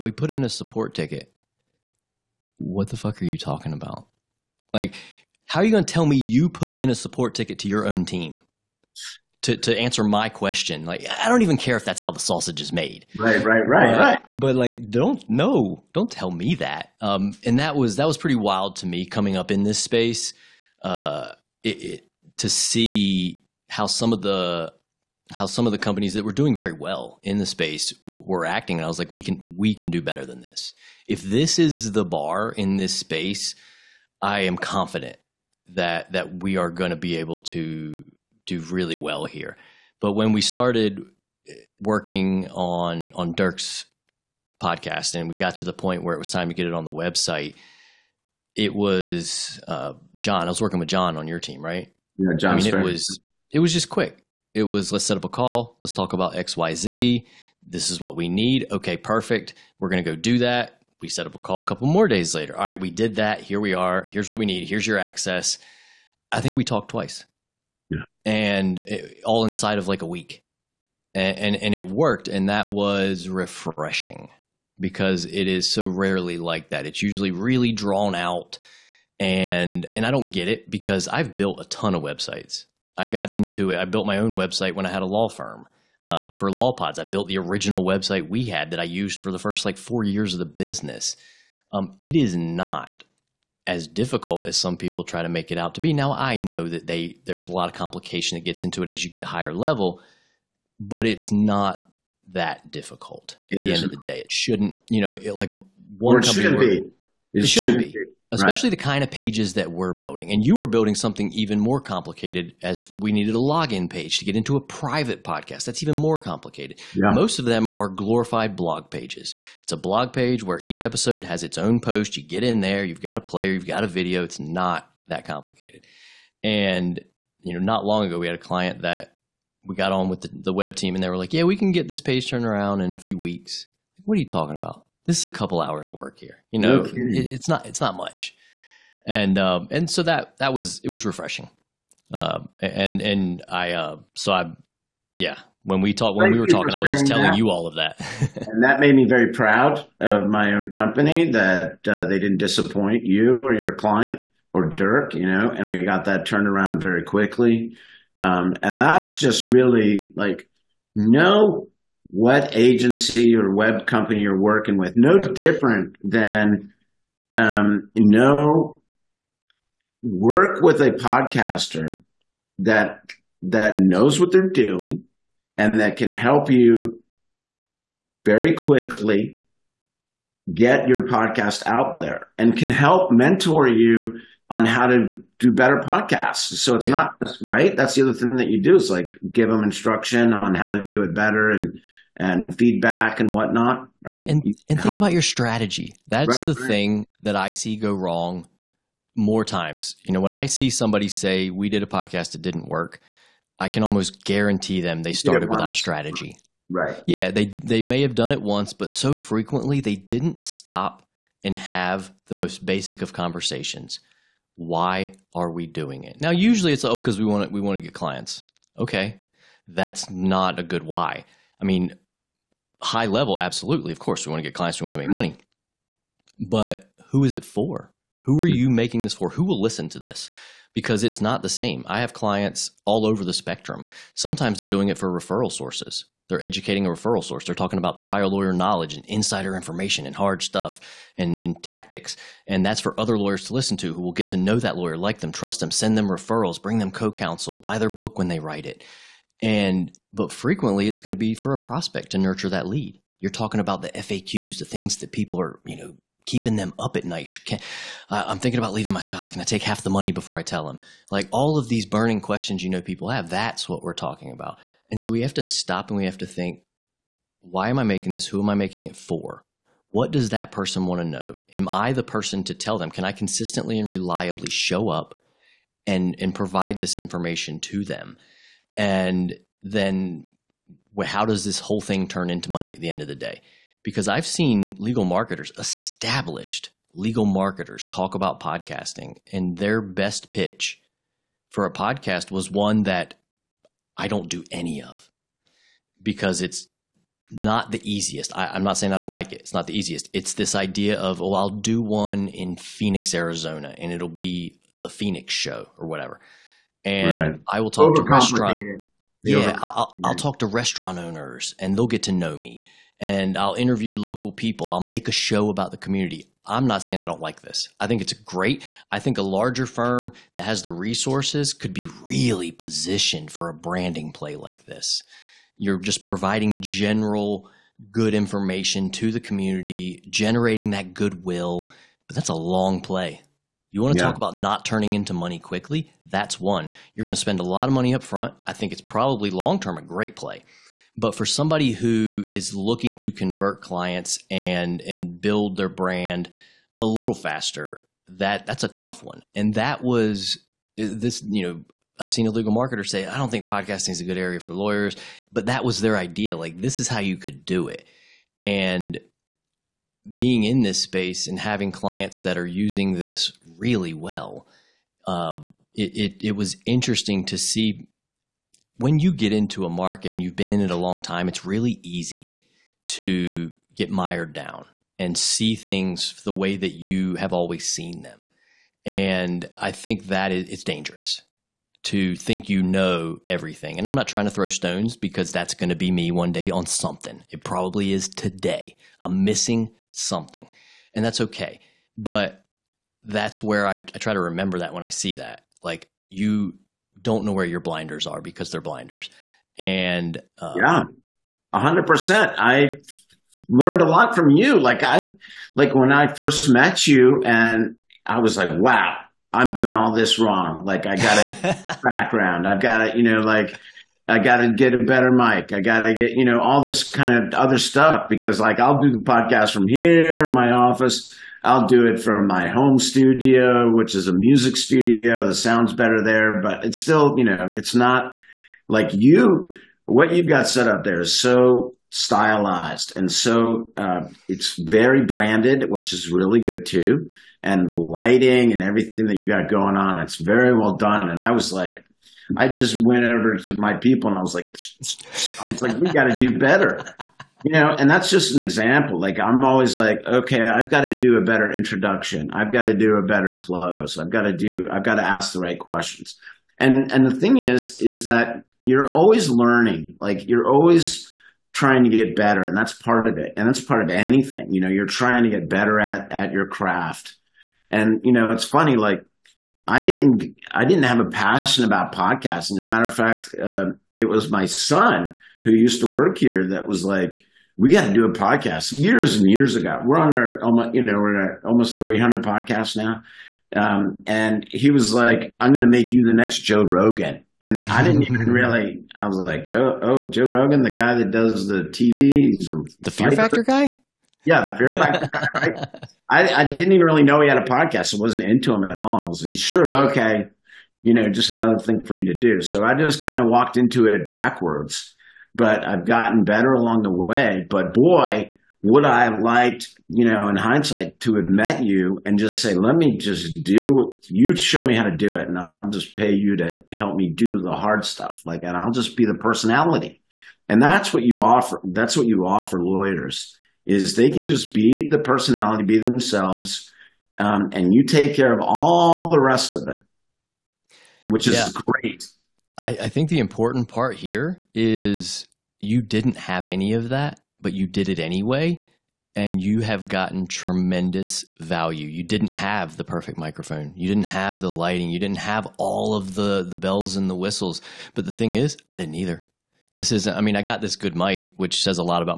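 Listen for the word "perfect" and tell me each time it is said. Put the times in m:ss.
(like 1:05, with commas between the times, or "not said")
0:58, 9:02.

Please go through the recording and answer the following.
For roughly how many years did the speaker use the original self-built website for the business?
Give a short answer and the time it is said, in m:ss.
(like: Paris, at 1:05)
4, at 1:29.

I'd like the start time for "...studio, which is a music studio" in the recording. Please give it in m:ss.
7:02.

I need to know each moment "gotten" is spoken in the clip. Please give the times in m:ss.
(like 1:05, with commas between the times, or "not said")
8:25, 8:59.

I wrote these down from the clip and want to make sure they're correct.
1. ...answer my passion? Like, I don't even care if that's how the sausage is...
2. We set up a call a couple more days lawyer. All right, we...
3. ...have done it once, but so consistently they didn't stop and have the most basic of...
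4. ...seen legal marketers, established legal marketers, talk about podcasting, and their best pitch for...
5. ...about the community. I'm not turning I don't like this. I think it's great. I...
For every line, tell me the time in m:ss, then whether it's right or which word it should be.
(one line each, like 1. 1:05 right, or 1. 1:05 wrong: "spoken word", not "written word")
1. 0:09 wrong: "question", not "passion"
2. 1:01 wrong: "later", not "lawyer"
3. 3:28 wrong: "frequently", not "consistently"
4. 4:44 right
5. 5:15 wrong: "saying", not "turning".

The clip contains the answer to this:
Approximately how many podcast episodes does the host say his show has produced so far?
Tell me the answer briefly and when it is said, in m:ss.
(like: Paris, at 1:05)
300, at 8:01.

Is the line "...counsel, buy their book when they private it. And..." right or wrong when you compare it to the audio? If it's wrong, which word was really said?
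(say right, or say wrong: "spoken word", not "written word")
wrong: "write", not "private".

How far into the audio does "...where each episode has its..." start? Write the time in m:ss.
2:00.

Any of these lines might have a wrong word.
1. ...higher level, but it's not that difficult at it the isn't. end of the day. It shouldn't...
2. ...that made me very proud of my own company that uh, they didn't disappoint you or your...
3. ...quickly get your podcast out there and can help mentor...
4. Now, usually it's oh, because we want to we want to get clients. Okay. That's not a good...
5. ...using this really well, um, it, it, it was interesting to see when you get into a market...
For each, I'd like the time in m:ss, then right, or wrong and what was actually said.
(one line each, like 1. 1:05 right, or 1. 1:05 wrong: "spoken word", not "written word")
1. 1:39 right
2. 2:28 right
3. 2:58 right
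4. 3:36 right
5. 6:02 right.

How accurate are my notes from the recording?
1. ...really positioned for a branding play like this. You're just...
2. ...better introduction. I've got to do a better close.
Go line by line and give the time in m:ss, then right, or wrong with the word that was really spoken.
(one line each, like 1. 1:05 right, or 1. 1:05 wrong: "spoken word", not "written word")
1. 5:22 right
2. 7:31 right.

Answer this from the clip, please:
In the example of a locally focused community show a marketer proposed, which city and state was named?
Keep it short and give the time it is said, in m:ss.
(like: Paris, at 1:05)
Phoenix, Arizona, at 5:02.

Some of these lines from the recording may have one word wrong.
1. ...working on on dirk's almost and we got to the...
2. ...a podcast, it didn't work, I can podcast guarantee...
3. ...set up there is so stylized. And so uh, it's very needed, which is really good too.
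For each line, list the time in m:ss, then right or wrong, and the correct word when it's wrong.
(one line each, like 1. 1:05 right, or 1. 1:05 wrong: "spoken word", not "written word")
1. 0:41 wrong: "podcast", not "almost"
2. 3:21 wrong: "almost", not "podcast"
3. 7:10 wrong: "branded", not "needed".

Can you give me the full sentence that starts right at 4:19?
Can I take half the money before I tell them?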